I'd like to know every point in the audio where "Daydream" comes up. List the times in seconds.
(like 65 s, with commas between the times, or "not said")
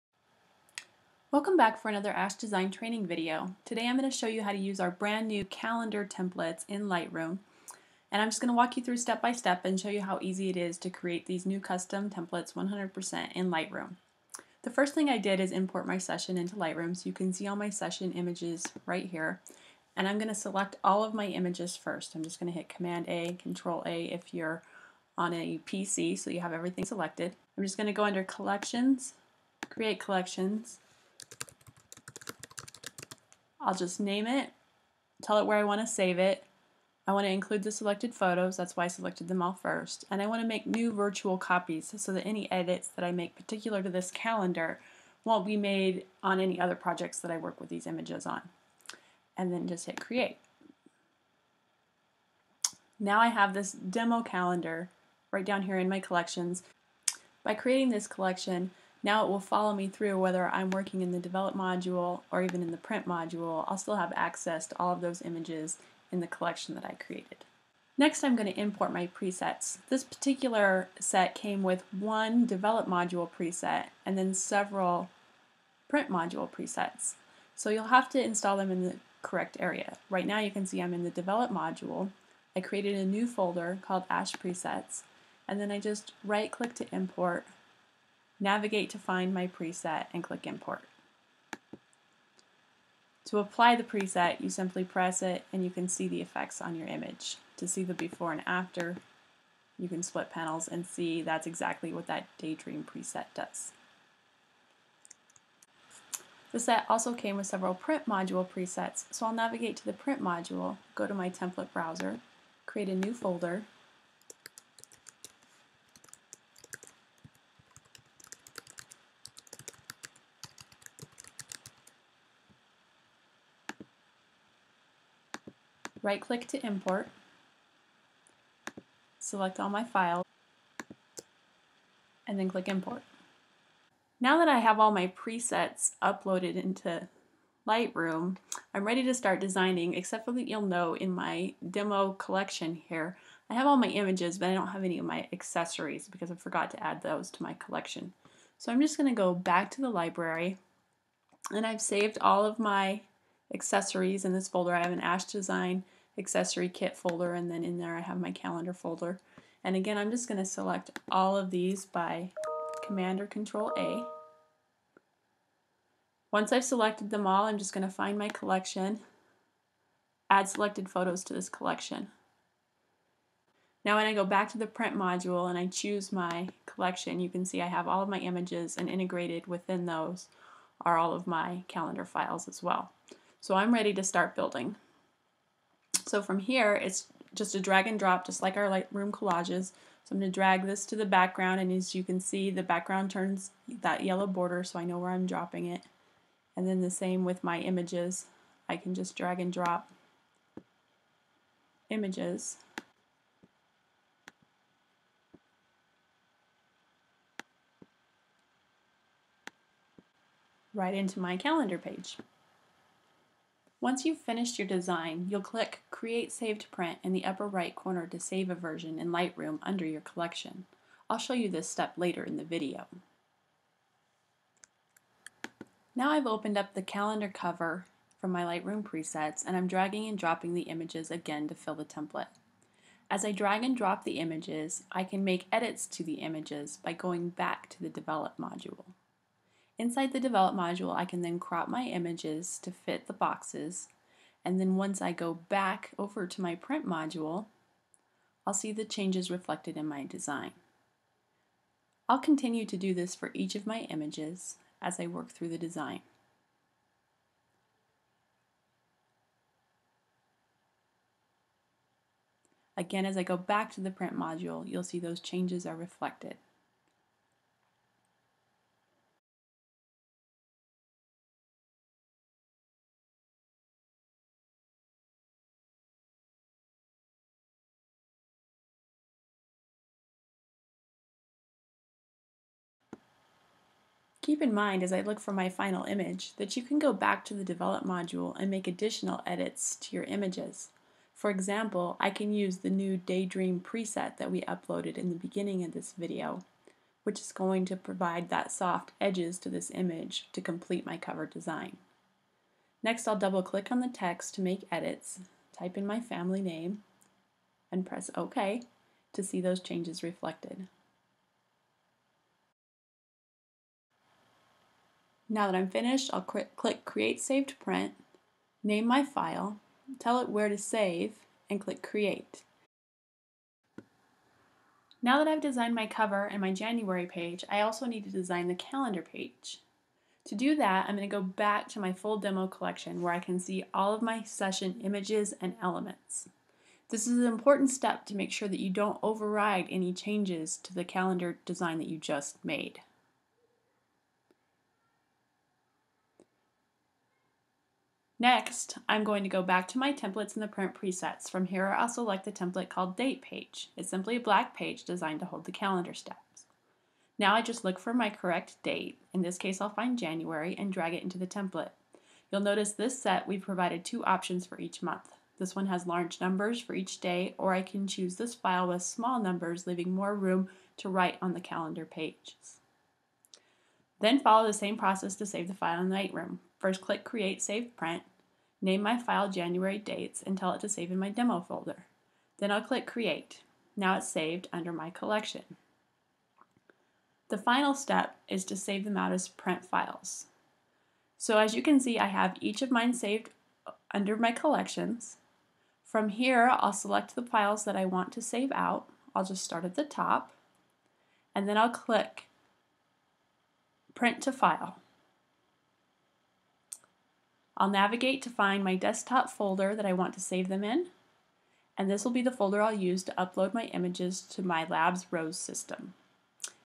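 102 s, 292 s.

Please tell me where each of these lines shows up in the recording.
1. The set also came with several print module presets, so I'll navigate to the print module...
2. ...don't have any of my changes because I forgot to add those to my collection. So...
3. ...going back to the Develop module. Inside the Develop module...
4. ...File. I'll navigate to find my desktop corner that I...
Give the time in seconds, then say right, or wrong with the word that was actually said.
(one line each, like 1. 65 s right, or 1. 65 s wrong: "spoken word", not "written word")
1. 106 s right
2. 144 s wrong: "accessories", not "changes"
3. 236 s right
4. 404 s wrong: "folder", not "corner".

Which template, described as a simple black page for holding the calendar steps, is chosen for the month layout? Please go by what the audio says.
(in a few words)
date page.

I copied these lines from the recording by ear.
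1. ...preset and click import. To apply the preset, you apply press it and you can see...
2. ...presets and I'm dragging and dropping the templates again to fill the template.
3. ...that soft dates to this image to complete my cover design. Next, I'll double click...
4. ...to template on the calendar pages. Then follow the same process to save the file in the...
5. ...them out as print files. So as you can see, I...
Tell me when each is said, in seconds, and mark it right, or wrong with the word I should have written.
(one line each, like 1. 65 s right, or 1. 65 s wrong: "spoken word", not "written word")
1. 89 s wrong: "simply", not "apply"
2. 228 s wrong: "images", not "templates"
3. 298 s wrong: "edges", not "dates"
4. 370 s wrong: "write", not "template"
5. 388 s right.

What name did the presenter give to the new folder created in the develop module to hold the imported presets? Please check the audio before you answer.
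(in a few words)
Ashe presets.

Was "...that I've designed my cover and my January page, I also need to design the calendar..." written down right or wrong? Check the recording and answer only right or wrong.
right.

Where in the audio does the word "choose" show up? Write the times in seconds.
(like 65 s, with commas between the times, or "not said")
175 s, 367 s.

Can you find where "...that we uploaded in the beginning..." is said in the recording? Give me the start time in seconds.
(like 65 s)
294 s.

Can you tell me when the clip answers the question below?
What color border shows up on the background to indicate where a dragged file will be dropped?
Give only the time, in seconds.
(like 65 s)
194 s.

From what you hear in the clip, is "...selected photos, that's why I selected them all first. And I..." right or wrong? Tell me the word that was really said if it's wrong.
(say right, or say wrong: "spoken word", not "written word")
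right.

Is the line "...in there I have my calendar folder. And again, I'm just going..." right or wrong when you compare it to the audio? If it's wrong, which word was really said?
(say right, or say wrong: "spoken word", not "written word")
right.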